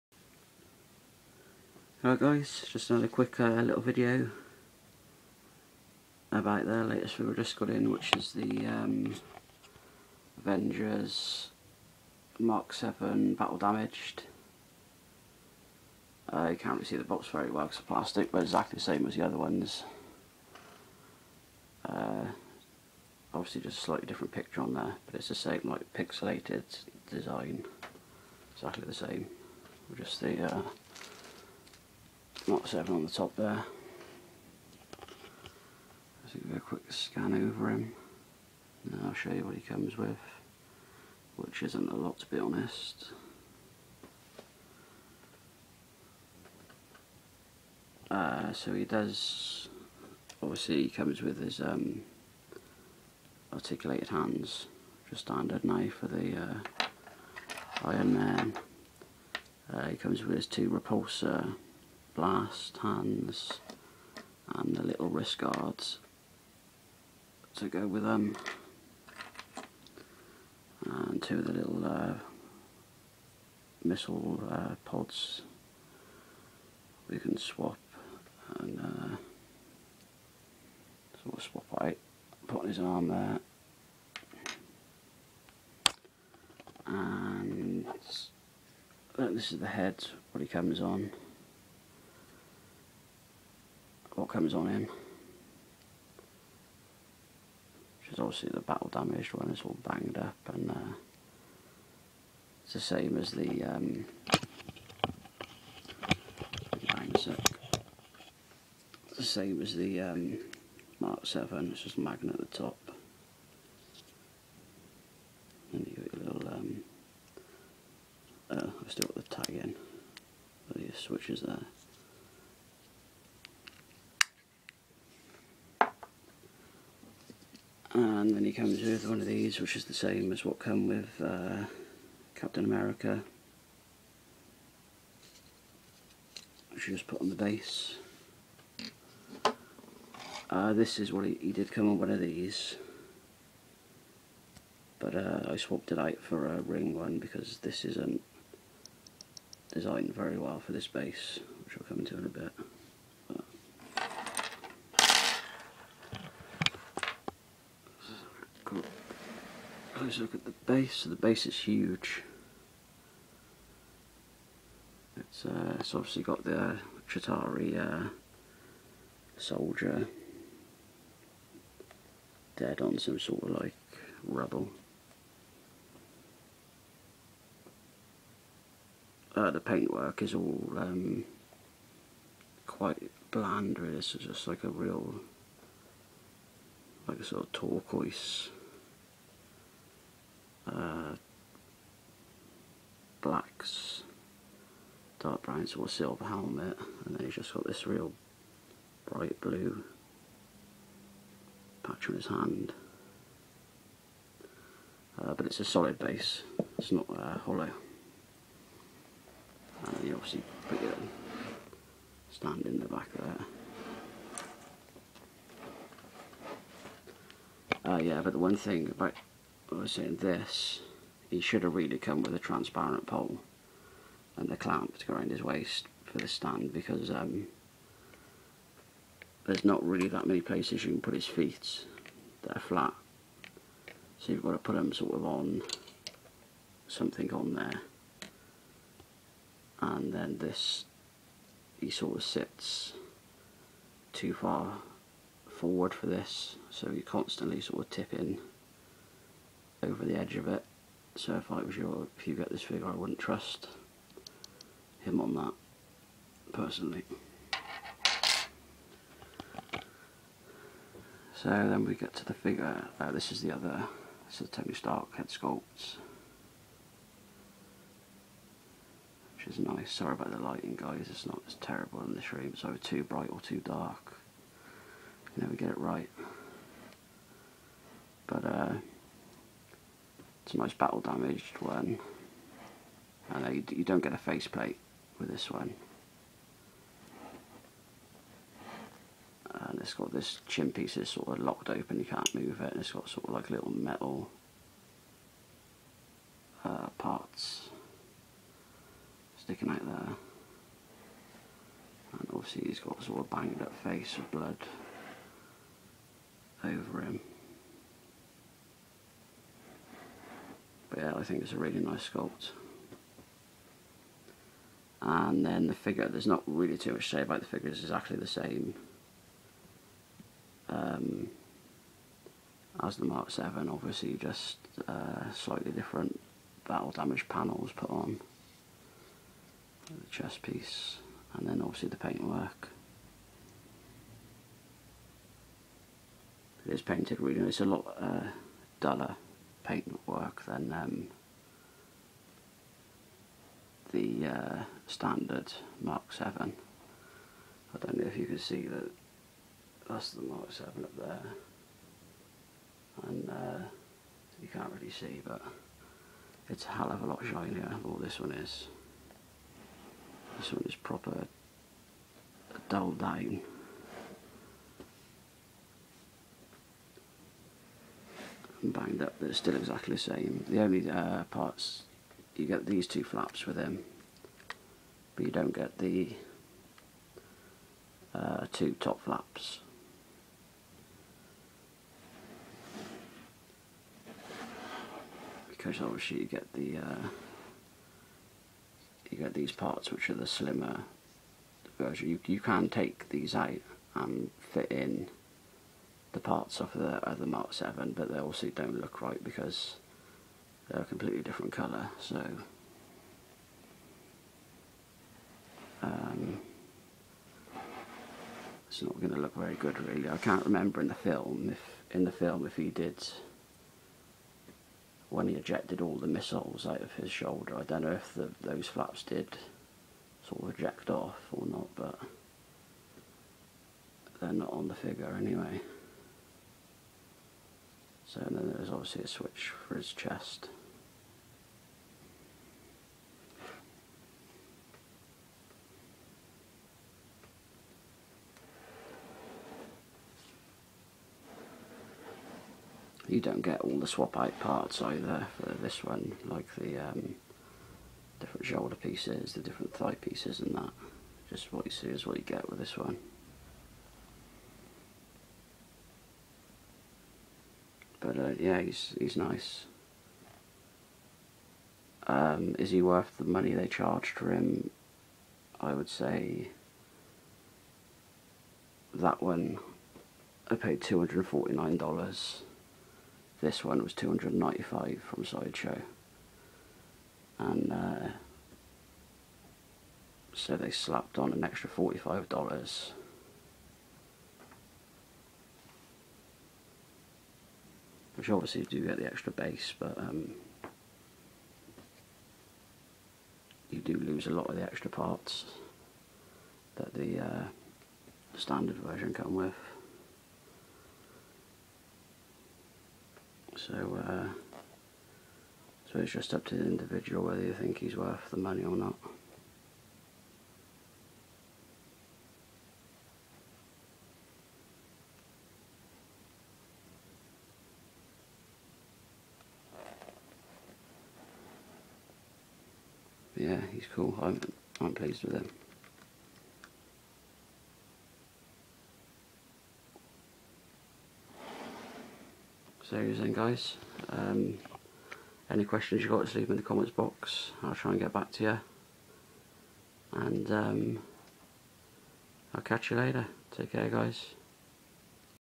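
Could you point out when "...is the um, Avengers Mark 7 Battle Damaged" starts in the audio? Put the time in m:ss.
0:08.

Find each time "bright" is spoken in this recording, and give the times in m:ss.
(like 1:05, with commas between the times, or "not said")
3:19, 4:33.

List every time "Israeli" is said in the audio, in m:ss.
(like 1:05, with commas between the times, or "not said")
not said.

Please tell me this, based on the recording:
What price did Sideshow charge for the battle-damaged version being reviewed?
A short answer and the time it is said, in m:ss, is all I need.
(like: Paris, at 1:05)
$295, at 7:53.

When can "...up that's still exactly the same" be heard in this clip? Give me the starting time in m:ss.
6:09.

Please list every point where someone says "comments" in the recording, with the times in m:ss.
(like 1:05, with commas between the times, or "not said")
8:56.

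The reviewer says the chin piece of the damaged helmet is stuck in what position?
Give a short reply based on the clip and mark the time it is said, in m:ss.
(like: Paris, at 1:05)
Locked open, at 4:51.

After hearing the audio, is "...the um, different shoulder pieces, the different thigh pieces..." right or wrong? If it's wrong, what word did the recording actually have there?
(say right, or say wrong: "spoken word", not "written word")
right.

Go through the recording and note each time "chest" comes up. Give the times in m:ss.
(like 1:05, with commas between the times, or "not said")
5:30, 7:09.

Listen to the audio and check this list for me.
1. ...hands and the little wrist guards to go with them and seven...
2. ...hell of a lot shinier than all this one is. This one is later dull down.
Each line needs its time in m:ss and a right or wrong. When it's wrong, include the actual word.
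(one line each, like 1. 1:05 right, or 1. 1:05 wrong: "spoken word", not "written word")
1. 1:02 wrong: "two", not "seven"
2. 5:56 wrong: "proper", not "later".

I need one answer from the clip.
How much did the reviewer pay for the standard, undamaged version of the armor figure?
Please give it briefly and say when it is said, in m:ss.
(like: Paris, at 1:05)
$249, at 7:50.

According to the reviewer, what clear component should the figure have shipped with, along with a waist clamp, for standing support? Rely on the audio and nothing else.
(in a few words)
A transparent pole.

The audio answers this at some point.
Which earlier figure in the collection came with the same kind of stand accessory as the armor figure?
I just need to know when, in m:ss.
2:12.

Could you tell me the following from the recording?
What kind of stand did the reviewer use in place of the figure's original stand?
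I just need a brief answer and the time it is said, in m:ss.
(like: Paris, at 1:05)
A ring one, at 2:26.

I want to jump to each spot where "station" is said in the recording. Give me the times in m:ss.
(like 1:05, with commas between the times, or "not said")
not said.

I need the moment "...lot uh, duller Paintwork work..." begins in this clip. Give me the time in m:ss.
5:37.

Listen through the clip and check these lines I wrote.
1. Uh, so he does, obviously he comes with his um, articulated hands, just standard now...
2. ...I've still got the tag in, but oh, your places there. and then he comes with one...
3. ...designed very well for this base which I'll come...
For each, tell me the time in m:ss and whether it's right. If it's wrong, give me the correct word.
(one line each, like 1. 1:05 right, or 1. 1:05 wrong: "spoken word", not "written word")
1. 0:48 right
2. 1:58 wrong: "switches", not "places"
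3. 2:29 right.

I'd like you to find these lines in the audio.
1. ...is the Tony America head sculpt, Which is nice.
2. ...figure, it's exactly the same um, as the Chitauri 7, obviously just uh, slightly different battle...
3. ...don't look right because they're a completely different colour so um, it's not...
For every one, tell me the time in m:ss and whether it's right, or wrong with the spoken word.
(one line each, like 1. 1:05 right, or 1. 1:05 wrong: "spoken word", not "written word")
1. 4:24 wrong: "Stark", not "America"
2. 5:17 wrong: "Mark", not "Chitauri"
3. 6:38 right.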